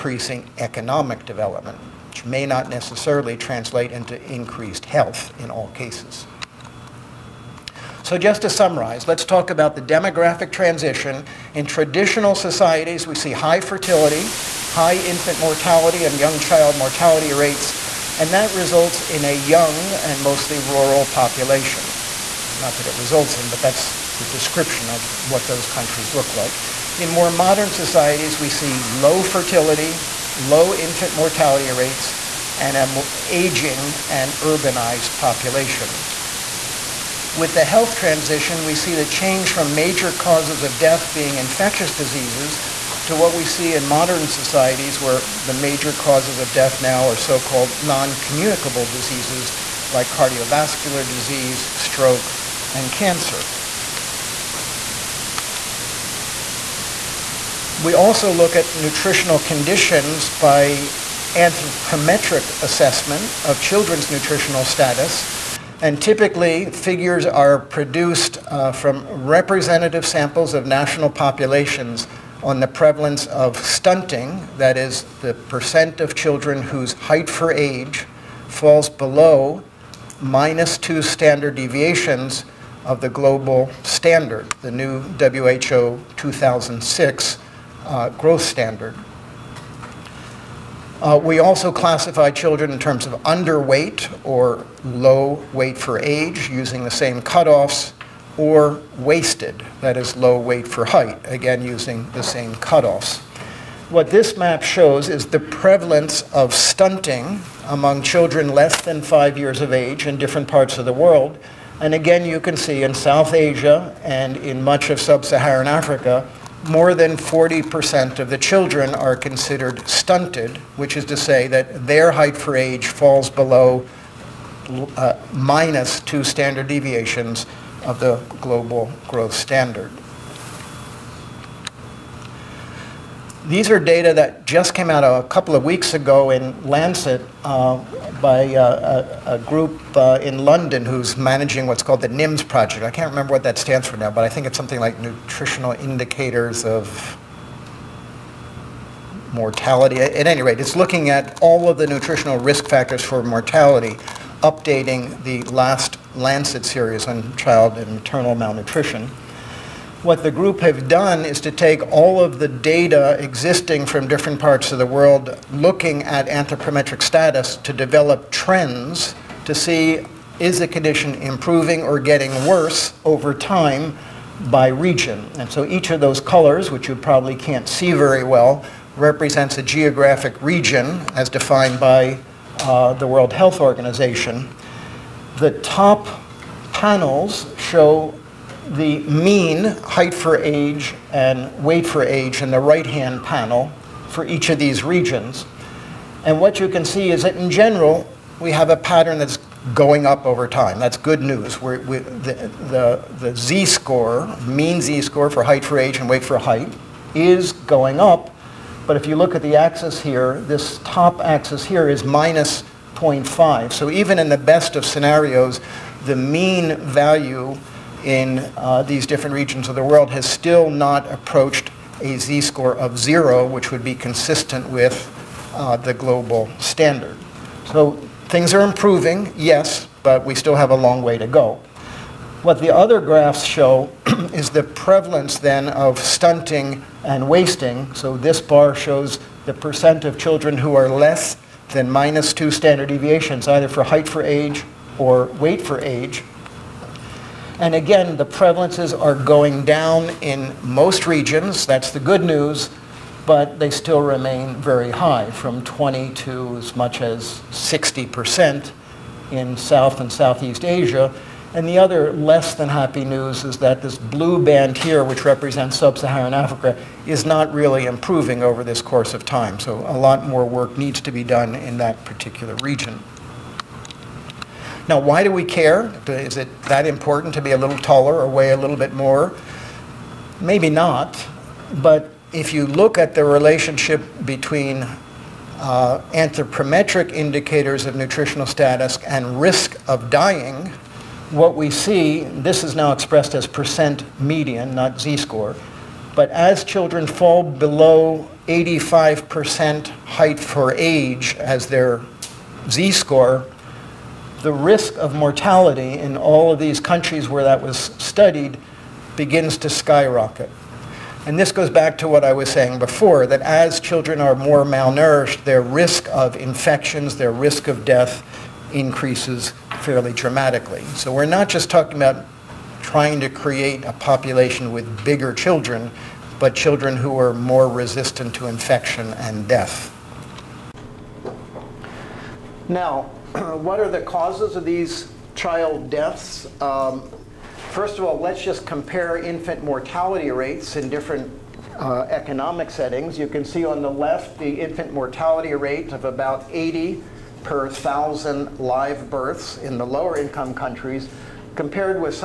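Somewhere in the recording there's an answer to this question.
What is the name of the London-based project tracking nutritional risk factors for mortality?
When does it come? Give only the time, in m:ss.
2:22.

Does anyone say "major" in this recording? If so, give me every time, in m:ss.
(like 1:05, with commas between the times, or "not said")
0:39, 0:45.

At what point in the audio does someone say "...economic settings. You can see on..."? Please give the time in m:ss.
5:42.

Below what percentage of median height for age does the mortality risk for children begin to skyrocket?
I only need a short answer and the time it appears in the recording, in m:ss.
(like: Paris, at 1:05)
85%, at 4:58.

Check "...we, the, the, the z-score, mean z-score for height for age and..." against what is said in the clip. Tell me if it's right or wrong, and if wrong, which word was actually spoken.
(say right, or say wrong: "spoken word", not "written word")
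right.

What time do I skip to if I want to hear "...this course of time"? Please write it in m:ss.
4:28.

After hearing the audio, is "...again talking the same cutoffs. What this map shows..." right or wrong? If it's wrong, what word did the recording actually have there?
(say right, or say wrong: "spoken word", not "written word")
wrong: "using", not "talking".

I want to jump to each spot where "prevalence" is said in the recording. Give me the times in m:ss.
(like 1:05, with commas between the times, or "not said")
1:12, 1:45, 3:54, 4:08.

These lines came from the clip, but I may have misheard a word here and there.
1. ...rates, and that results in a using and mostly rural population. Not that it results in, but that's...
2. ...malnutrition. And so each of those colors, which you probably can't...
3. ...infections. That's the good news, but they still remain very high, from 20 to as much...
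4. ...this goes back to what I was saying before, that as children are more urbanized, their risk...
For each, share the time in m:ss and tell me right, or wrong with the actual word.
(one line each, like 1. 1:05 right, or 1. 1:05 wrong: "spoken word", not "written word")
1. 0:17 wrong: "young", not "using"
2. 2:54 wrong: "region", not "malnutrition"
3. 4:11 wrong: "regions", not "infections"
4. 5:11 wrong: "malnourished", not "urbanized".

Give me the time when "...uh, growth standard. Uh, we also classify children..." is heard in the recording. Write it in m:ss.
1:27.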